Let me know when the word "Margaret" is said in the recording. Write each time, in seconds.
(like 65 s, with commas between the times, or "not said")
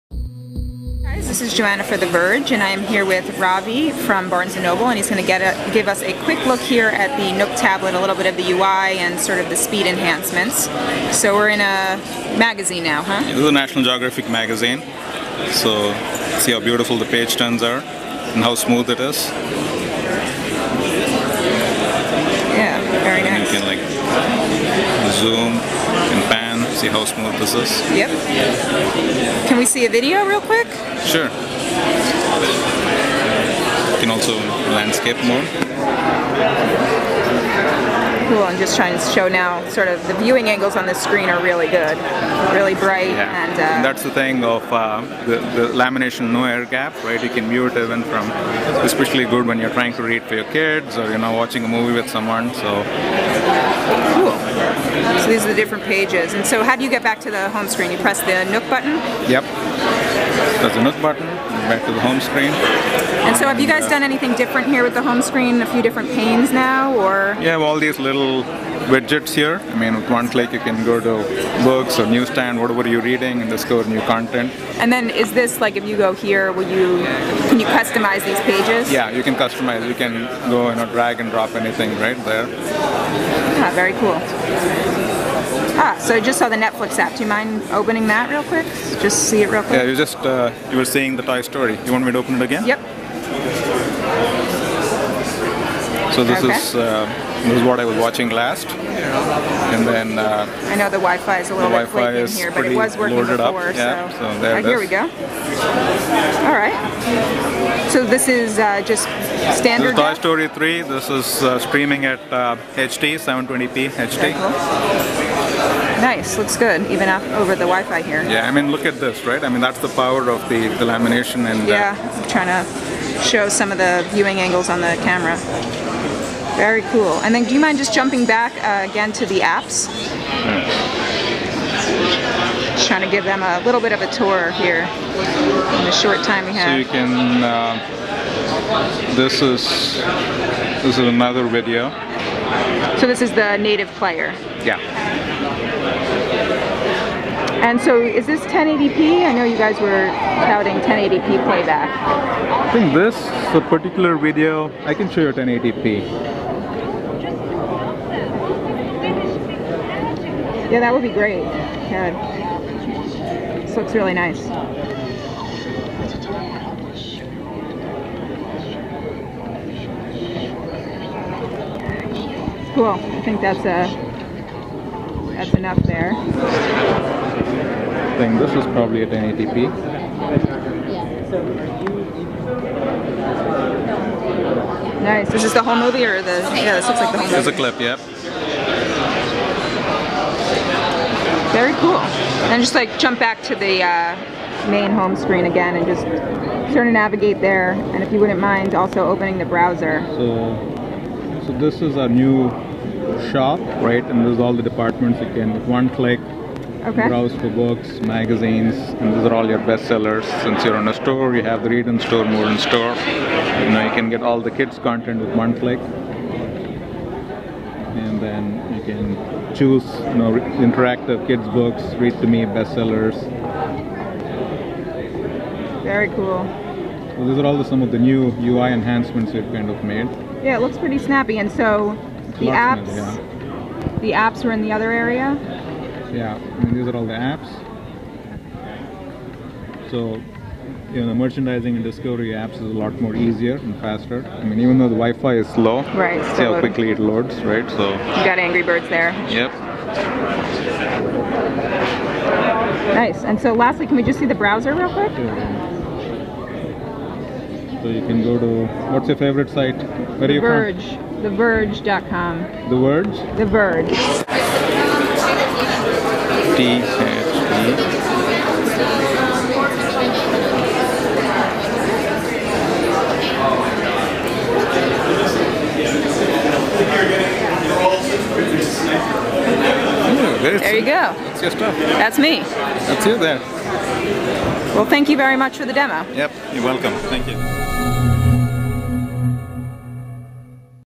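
not said.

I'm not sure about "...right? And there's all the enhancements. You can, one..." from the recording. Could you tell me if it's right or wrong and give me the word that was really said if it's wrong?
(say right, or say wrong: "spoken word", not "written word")
wrong: "departments", not "enhancements".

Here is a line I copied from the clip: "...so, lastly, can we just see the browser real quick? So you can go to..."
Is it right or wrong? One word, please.
right.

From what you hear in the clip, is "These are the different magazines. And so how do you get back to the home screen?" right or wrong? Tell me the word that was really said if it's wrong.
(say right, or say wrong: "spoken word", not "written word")
wrong: "pages", not "magazines".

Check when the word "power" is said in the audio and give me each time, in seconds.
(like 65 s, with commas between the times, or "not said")
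119 s.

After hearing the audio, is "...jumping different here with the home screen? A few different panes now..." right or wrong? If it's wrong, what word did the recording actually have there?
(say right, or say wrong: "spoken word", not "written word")
wrong: "anything", not "jumping".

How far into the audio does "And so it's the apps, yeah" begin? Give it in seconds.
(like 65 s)
231 s.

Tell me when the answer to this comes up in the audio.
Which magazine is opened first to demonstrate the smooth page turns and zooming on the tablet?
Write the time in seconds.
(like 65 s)
13 s.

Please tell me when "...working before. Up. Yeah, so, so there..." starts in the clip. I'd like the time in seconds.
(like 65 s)
102 s.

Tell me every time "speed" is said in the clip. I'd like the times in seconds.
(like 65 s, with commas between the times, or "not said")
9 s.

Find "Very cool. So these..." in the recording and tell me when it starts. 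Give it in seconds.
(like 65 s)
225 s.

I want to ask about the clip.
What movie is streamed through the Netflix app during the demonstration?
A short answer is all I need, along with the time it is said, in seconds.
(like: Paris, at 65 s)
Toy Story 3, at 110 s.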